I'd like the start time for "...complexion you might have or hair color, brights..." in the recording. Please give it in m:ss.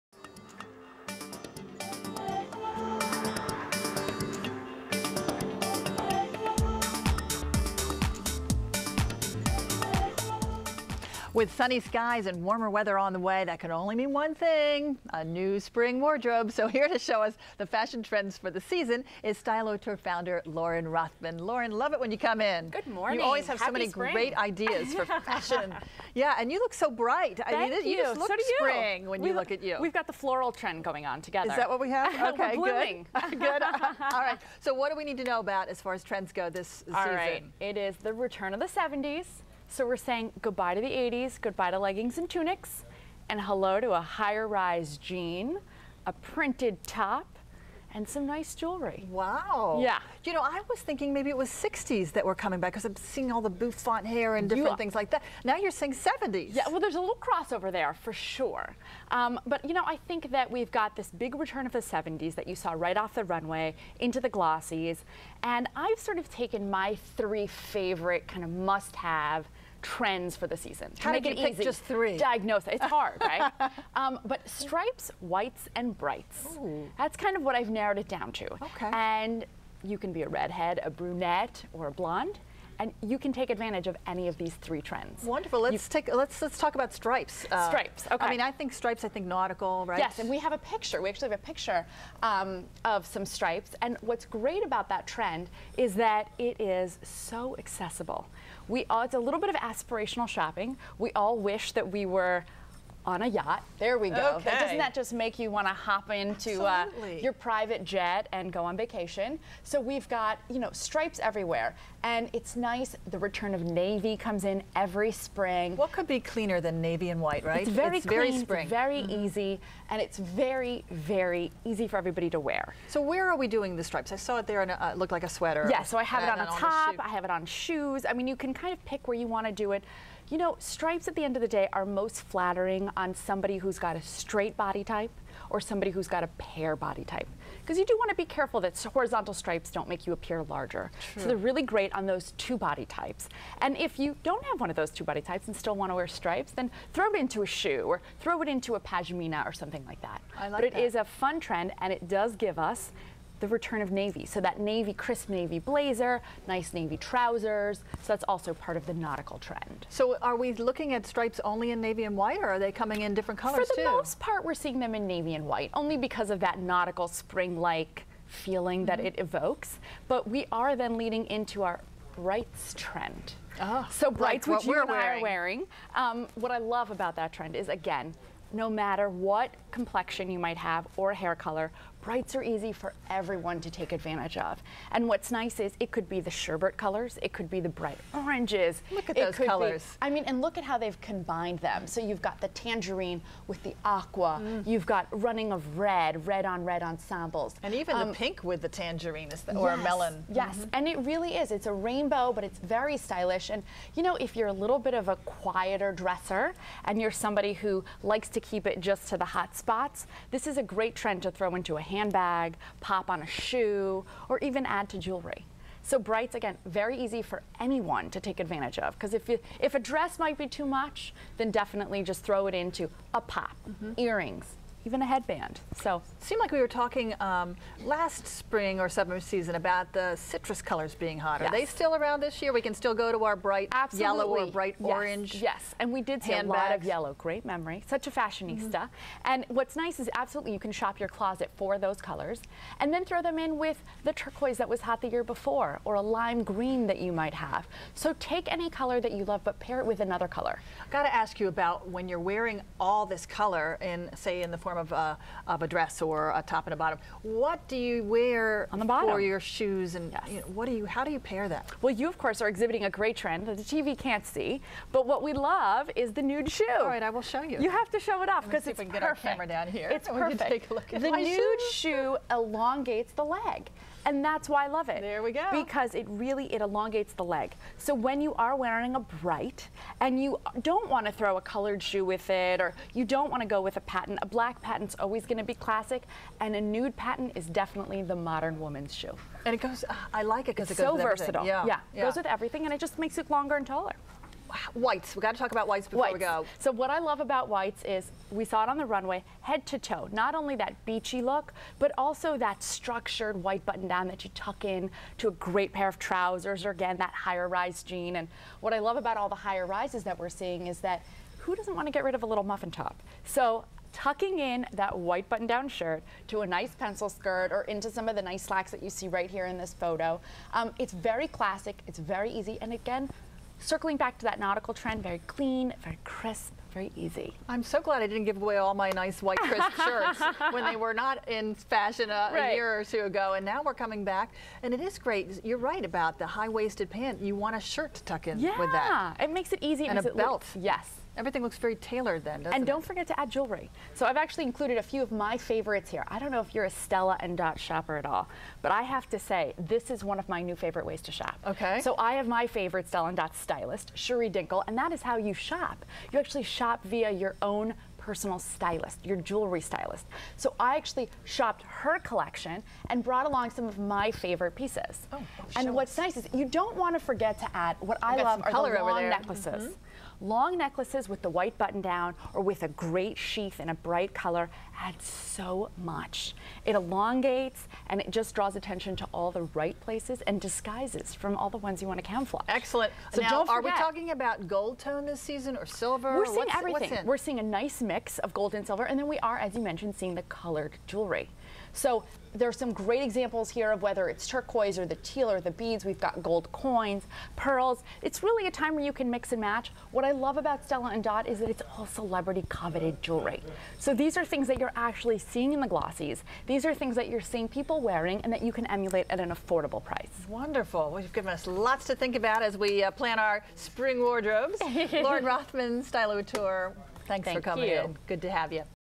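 2:59.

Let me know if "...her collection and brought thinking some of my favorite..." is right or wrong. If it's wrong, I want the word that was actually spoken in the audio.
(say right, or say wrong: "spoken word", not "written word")
wrong: "along", not "thinking".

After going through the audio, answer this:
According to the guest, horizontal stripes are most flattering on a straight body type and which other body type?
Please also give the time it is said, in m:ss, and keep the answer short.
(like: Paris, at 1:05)
pear, at 2:16.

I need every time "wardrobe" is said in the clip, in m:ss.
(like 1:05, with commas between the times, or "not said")
0:16, 6:53.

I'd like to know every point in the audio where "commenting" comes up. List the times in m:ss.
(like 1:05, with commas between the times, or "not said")
not said.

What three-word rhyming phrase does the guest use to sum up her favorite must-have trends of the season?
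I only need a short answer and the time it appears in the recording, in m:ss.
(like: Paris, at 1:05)
stripes, whites, and brights, at 1:14.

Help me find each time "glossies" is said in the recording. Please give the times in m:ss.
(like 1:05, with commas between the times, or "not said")
1:04, 6:45.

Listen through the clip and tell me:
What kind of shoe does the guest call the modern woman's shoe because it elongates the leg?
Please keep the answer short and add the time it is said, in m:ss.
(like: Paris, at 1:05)
nude patent, at 4:46.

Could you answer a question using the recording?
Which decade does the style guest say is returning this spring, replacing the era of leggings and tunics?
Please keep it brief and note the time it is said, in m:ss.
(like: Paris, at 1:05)
the 70s, at 0:37.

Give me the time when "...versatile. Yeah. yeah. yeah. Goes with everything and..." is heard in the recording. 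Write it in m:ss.
4:50.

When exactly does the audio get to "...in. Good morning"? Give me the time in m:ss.
0:22.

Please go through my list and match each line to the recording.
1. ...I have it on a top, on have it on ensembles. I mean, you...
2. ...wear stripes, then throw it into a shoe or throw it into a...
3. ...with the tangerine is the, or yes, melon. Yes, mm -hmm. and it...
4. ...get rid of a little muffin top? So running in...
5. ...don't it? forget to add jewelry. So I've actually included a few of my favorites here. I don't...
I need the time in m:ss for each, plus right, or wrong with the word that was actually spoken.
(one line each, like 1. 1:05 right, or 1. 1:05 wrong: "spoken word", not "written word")
1. 2:05 wrong: "shoes", not "ensembles"
2. 2:25 right
3. 3:18 right
4. 5:11 wrong: "tucking", not "running"
5. 5:42 right.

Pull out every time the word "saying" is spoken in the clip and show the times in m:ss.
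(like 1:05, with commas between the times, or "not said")
0:39, 0:55.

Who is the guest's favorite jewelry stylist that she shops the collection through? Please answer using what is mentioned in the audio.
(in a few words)
Shuri Dinkle.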